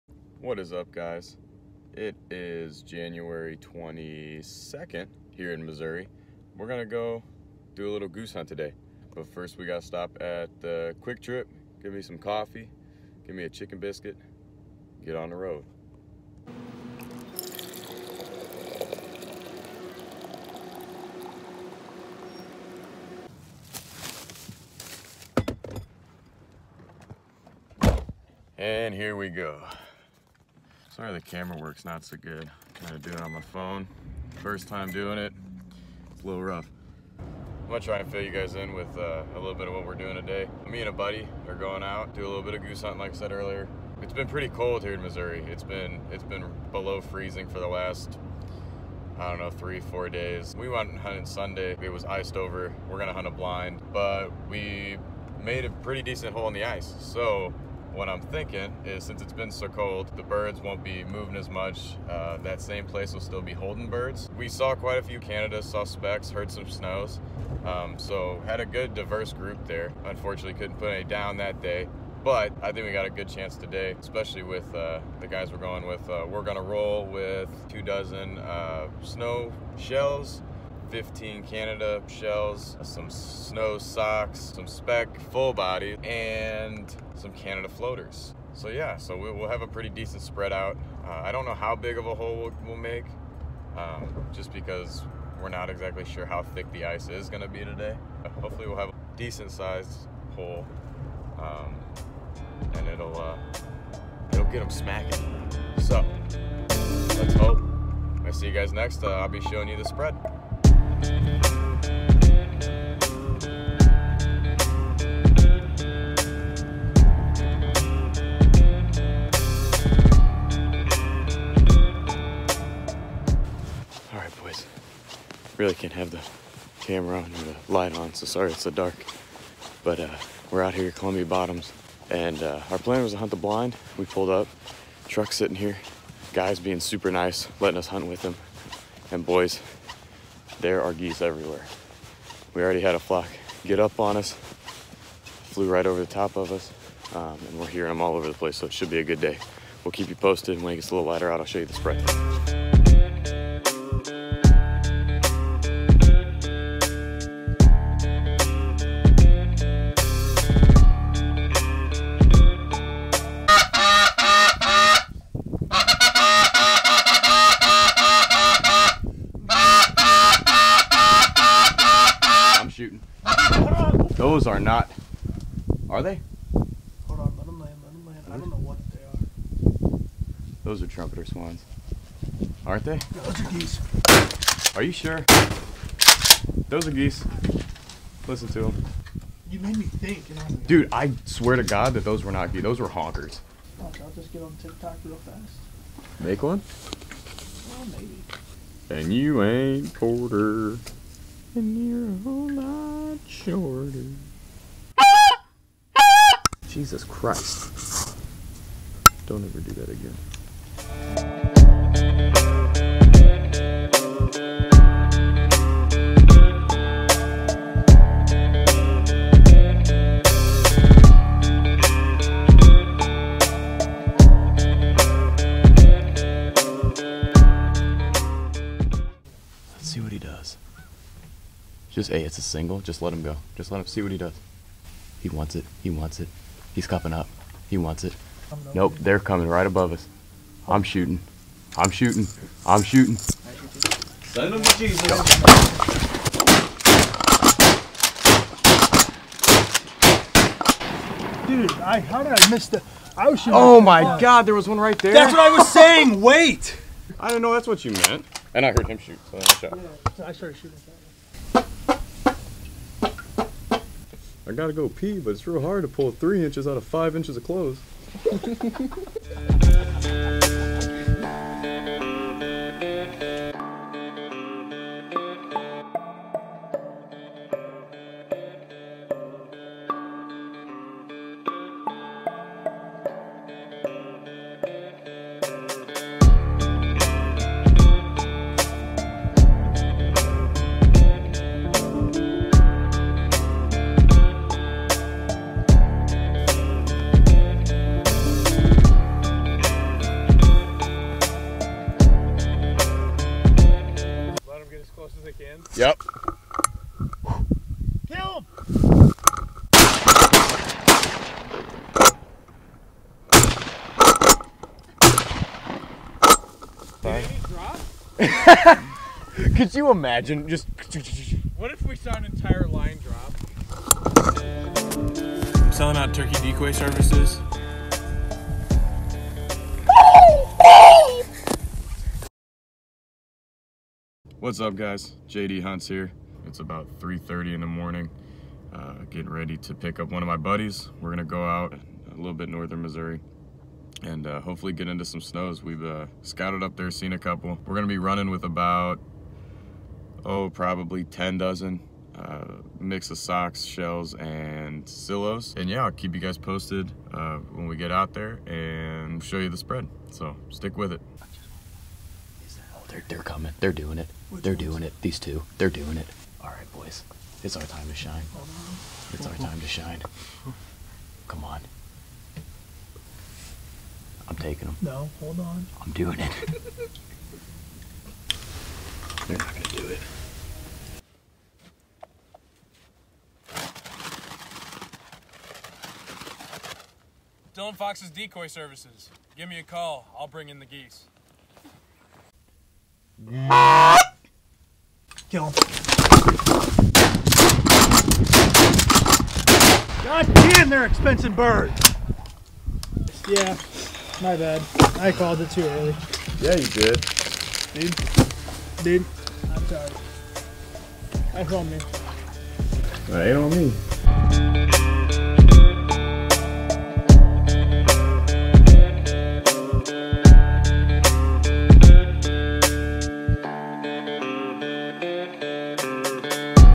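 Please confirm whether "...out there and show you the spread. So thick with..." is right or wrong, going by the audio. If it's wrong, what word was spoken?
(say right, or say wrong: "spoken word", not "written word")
wrong: "stick", not "thick".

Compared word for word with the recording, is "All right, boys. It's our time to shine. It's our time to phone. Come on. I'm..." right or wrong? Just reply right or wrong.
wrong.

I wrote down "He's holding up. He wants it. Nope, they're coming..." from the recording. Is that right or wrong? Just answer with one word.
wrong.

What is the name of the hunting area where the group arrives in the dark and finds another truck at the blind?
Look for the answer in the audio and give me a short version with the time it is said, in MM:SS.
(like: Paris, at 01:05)
Columbia Bottoms, at 02:10.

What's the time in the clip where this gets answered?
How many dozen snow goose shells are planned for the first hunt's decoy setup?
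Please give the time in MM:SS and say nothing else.
01:17.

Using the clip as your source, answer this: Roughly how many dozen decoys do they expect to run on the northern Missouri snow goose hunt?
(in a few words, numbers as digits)
10 dozen.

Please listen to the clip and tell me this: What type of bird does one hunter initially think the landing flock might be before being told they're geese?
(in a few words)
Trumpeter swans.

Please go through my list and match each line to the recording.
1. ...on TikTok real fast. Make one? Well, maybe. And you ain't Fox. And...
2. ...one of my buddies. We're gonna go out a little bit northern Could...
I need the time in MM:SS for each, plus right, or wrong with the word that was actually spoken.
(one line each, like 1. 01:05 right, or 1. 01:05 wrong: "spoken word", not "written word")
1. 03:14 wrong: "Porter", not "Fox"
2. 05:40 wrong: "Missouri", not "Could".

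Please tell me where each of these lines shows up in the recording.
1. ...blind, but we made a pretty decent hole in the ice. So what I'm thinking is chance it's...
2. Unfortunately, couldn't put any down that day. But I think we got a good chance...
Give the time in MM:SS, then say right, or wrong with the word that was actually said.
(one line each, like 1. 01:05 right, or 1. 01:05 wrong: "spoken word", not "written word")
1. 00:53 wrong: "since", not "chance"
2. 01:10 right.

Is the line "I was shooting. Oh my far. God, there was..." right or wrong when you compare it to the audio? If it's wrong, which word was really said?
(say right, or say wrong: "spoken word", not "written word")
right.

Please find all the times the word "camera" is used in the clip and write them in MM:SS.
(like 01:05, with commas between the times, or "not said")
00:31, 02:06.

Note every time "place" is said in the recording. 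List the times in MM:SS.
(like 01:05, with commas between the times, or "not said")
01:02, 02:28.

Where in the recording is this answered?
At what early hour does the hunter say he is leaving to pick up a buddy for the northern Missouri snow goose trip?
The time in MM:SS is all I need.
05:36.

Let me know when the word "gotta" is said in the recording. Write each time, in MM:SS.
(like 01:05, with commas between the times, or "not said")
00:09, 04:24.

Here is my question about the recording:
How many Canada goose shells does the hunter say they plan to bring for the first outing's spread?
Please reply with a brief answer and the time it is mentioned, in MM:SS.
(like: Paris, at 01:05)
15, at 01:20.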